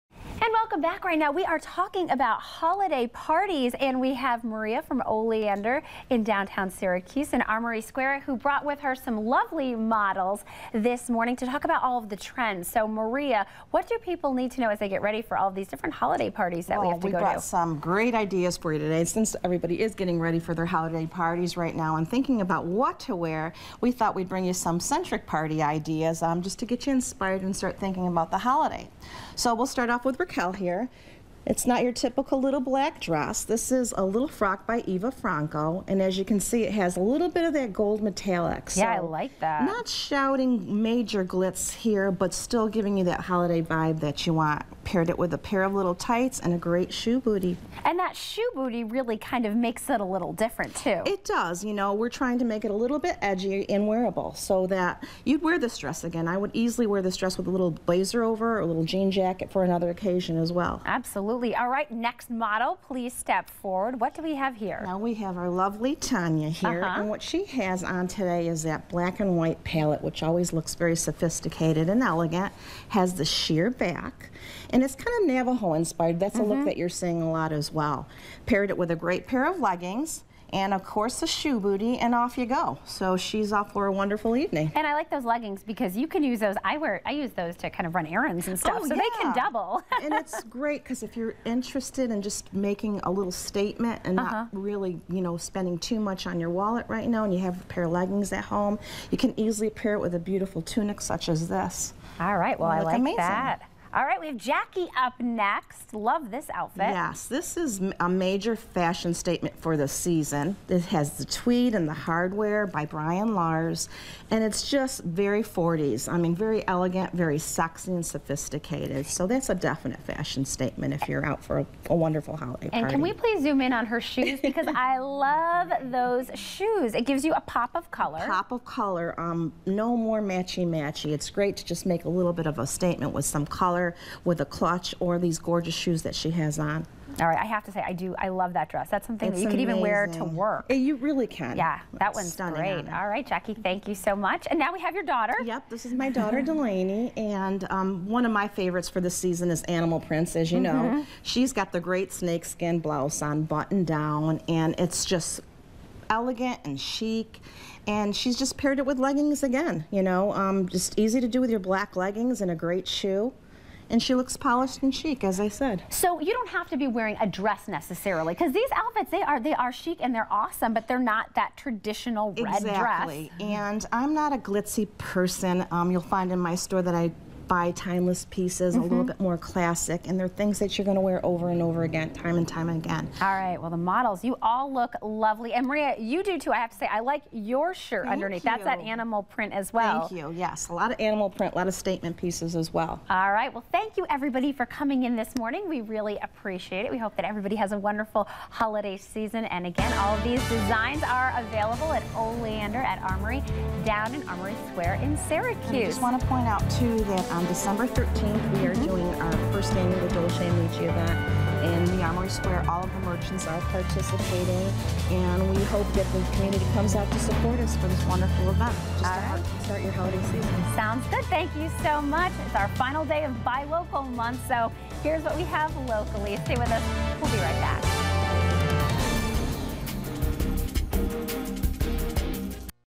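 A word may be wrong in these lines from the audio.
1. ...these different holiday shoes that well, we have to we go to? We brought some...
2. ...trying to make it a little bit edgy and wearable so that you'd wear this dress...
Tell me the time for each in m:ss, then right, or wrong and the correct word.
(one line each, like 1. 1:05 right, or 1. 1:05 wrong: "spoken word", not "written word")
1. 0:15 wrong: "parties", not "shoes"
2. 0:52 right.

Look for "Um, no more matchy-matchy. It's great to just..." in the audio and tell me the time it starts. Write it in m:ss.
2:09.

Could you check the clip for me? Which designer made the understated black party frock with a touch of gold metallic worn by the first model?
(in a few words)
Eva Franco.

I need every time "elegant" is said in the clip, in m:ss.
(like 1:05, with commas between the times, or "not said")
1:12, 1:56, 2:36.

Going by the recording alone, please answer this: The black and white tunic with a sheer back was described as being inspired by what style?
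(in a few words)
Navajo.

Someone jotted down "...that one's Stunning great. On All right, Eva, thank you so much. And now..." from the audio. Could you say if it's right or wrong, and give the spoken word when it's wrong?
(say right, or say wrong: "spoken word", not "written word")
wrong: "Jackie", not "Eva".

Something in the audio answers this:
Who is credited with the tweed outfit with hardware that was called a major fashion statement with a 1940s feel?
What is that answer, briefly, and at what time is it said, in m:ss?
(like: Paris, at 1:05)
Brian Lars, at 1:52.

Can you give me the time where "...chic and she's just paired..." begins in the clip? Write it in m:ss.
2:36.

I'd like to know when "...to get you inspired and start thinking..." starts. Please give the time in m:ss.
0:26.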